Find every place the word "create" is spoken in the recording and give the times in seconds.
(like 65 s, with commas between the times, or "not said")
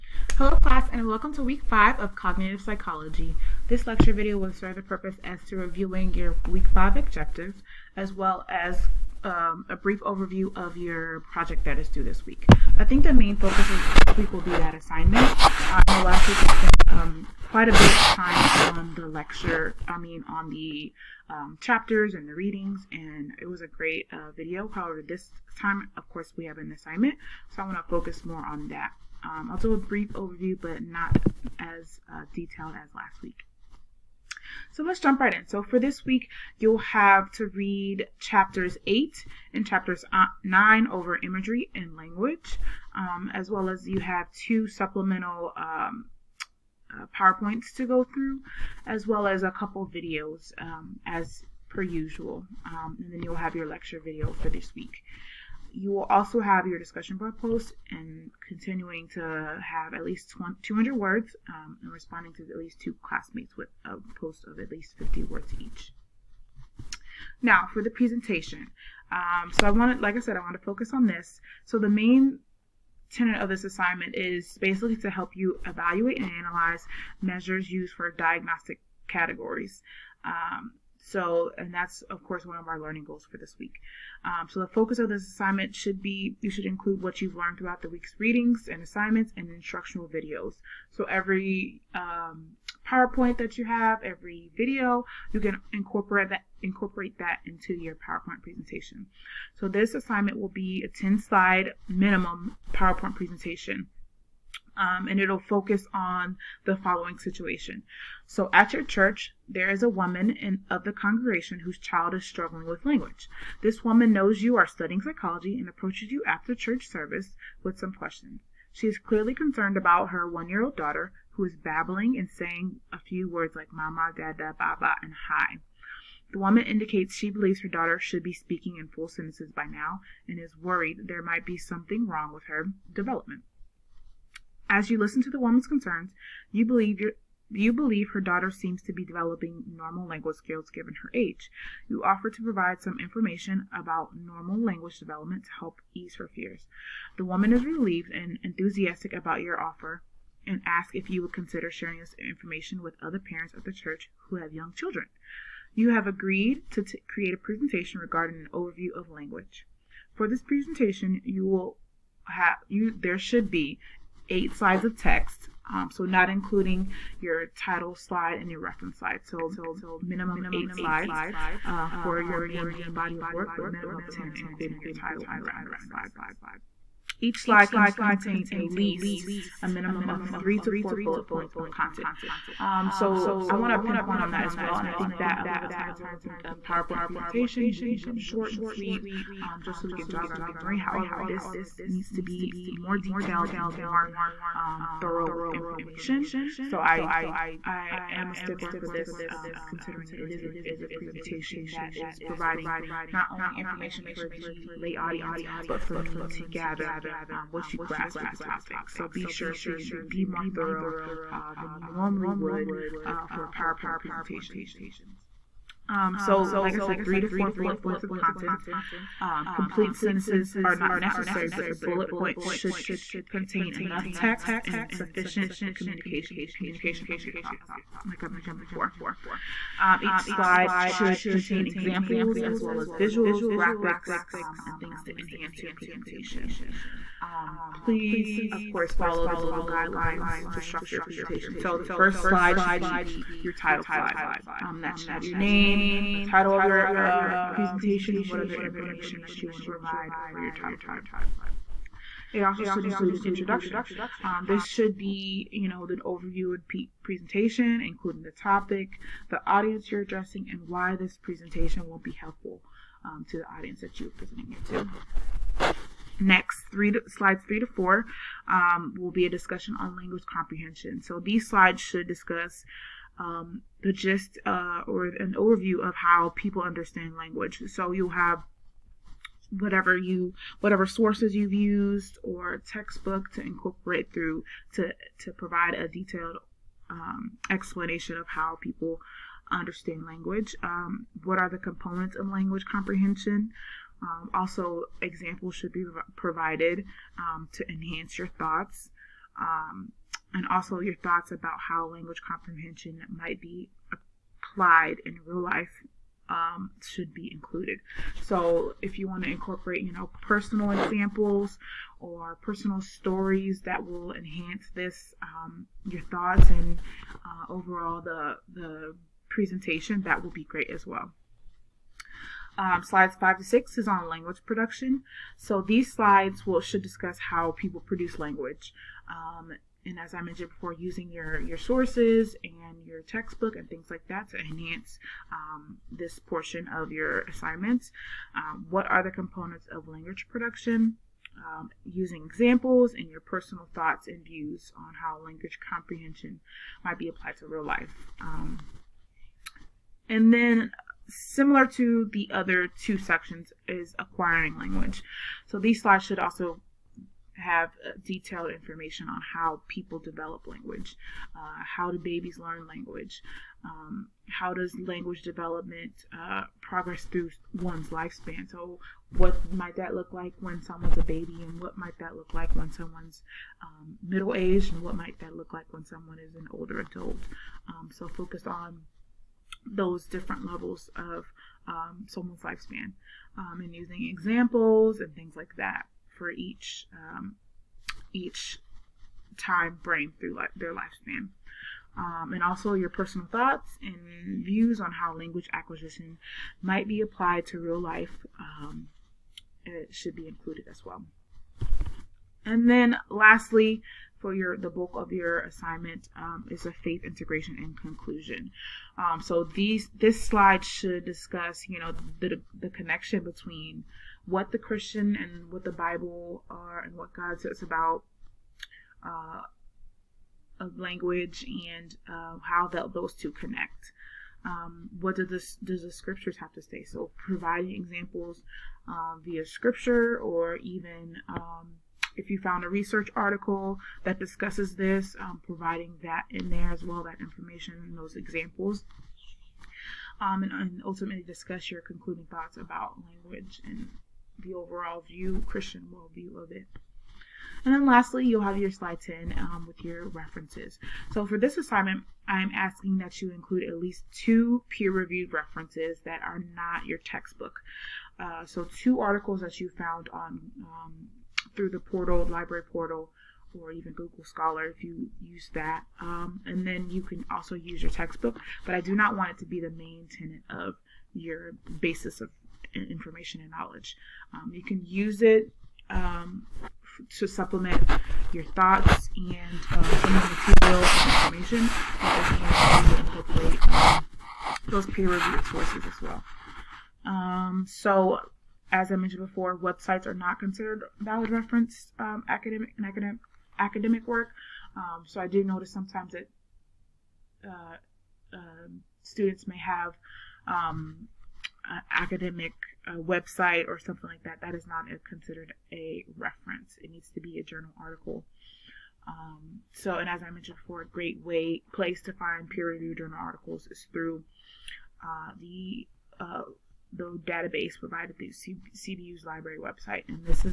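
157 s.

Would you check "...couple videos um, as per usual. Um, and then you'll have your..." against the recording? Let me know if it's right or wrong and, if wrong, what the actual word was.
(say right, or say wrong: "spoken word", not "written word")
right.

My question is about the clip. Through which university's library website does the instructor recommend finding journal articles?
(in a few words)
CBU.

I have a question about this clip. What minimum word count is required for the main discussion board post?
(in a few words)
200.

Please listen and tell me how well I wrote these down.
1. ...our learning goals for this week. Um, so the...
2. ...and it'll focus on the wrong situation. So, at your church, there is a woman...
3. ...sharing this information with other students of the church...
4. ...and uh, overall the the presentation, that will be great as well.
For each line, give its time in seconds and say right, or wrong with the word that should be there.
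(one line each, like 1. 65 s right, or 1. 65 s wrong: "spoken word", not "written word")
1. 82 s right
2. 105 s wrong: "following", not "wrong"
3. 151 s wrong: "parents", not "students"
4. 316 s right.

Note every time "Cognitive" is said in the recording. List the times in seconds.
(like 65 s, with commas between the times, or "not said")
2 s.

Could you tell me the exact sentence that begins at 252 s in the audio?
It also should include an introduction.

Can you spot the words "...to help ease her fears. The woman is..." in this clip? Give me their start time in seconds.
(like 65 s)
145 s.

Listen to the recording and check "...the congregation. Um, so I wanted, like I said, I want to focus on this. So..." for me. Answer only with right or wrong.
wrong.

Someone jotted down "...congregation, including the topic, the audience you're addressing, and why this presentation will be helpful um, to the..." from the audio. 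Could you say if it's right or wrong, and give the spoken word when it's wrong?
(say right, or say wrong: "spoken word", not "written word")
wrong: "presentation", not "congregation".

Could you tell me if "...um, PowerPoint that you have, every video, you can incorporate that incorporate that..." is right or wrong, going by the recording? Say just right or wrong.
right.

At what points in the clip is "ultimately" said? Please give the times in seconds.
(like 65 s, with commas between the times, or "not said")
440 s.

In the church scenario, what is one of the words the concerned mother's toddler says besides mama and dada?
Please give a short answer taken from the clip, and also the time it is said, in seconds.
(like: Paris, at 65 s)
baba, at 124 s.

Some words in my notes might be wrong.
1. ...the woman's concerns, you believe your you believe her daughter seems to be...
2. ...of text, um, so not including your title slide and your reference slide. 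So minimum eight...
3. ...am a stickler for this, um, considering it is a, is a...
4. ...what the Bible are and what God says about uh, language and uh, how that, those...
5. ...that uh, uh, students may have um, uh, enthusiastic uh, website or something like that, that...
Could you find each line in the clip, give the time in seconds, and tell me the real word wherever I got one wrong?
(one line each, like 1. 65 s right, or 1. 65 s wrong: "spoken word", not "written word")
1. 135 s right
2. 164 s right
3. 198 s right
4. 415 s right
5. 496 s wrong: "academic", not "enthusiastic".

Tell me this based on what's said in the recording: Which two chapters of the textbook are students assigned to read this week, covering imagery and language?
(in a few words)
8 and 9.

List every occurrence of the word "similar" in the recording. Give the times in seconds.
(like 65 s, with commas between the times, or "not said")
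351 s.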